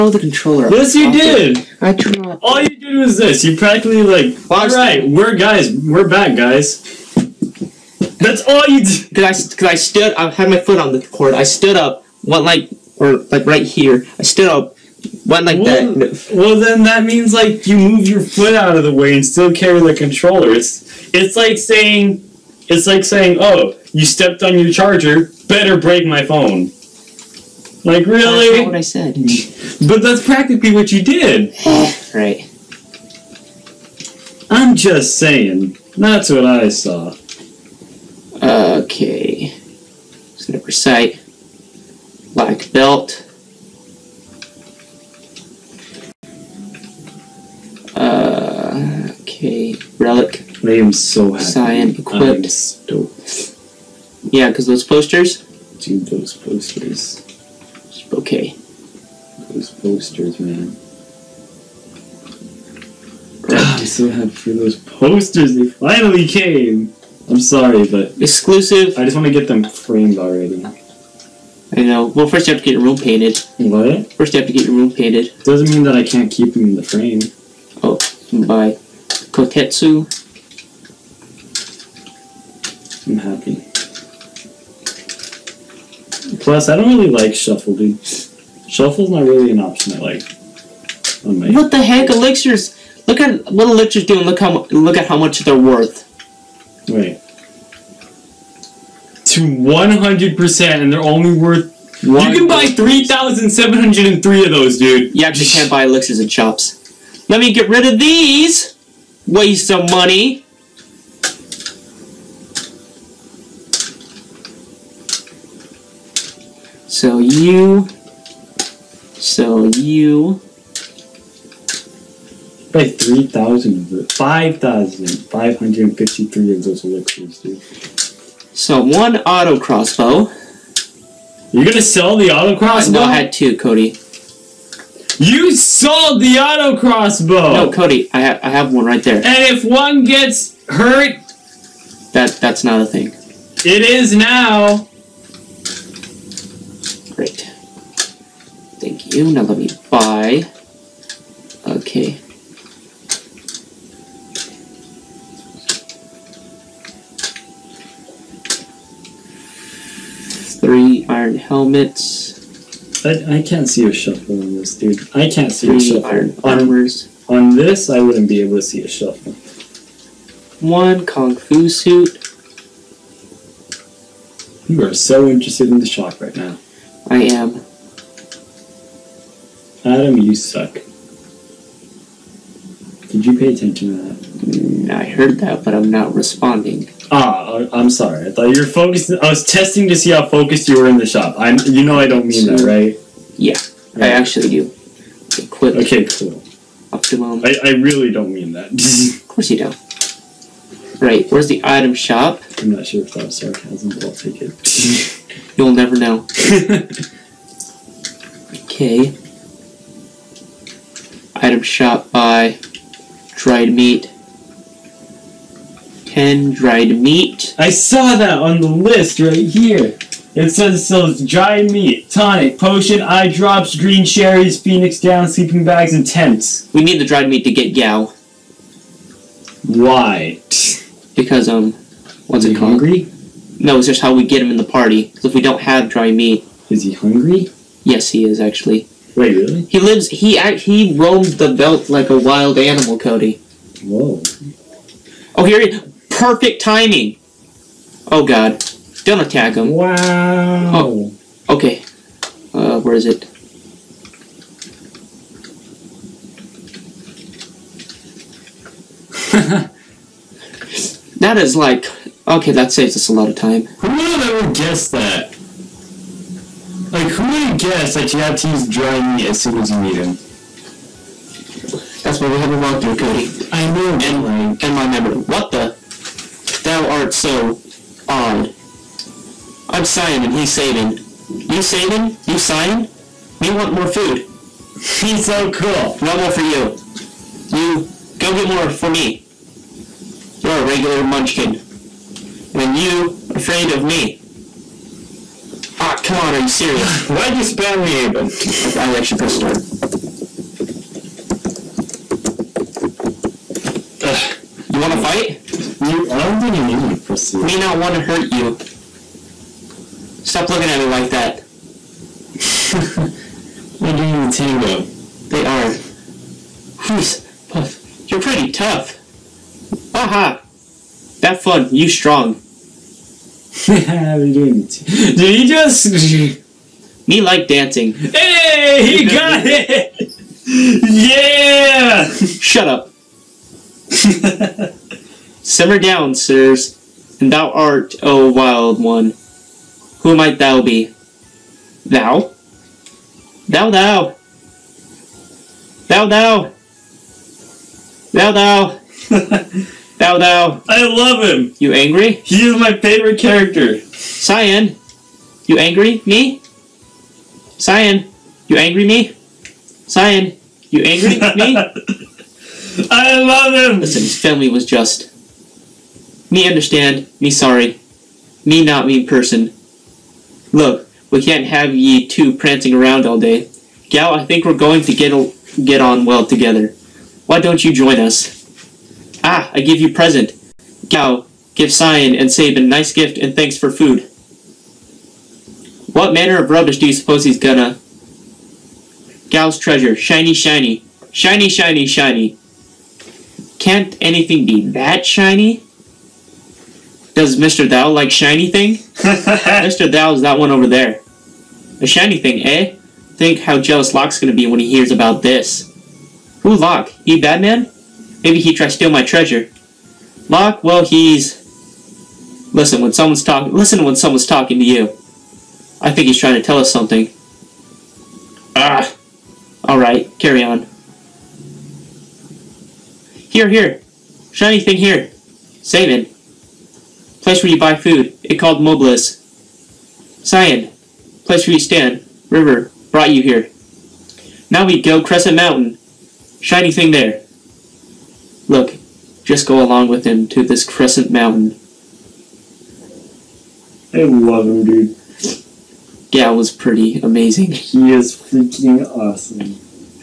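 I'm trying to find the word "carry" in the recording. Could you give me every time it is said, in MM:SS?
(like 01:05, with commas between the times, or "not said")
00:19, 07:00.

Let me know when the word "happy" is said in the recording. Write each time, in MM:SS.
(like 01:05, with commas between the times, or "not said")
00:51, 01:04, 01:23.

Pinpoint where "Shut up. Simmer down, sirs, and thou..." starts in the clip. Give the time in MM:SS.
05:32.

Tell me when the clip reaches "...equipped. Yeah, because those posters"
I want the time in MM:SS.
00:51.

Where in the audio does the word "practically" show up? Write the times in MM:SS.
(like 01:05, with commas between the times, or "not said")
00:03, 00:30.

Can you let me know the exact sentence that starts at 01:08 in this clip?
I just want to get them framed already.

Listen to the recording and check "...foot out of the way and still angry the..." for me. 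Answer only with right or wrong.
wrong.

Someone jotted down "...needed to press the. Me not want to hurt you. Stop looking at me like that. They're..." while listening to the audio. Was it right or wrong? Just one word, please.
right.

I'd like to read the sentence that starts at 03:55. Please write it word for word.
Because if we don't have dry meat, is he hungry?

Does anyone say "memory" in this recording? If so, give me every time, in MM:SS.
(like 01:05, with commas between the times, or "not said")
04:34.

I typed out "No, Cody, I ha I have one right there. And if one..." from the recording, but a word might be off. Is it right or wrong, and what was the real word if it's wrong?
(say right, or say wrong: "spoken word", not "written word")
right.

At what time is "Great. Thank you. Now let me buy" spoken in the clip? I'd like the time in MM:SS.
02:27.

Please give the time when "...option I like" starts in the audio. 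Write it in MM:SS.
01:29.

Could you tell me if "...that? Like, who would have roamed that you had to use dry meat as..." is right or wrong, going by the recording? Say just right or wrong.
wrong.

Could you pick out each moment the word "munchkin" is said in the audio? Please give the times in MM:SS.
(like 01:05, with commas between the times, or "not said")
04:51.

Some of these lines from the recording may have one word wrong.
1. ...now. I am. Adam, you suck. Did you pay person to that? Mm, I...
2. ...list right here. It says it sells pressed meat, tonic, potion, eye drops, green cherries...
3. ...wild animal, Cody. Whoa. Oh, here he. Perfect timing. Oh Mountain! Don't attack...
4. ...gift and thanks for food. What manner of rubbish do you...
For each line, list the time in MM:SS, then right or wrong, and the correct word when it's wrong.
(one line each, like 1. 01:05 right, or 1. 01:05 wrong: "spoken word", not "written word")
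1. 02:56 wrong: "attention", not "person"
2. 03:38 wrong: "dried", not "pressed"
3. 04:02 wrong: "God", not "Mountain"
4. 06:22 right.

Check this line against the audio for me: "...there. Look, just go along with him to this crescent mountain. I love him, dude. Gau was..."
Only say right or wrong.
right.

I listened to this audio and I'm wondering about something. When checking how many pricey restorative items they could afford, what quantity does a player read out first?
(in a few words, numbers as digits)
3703.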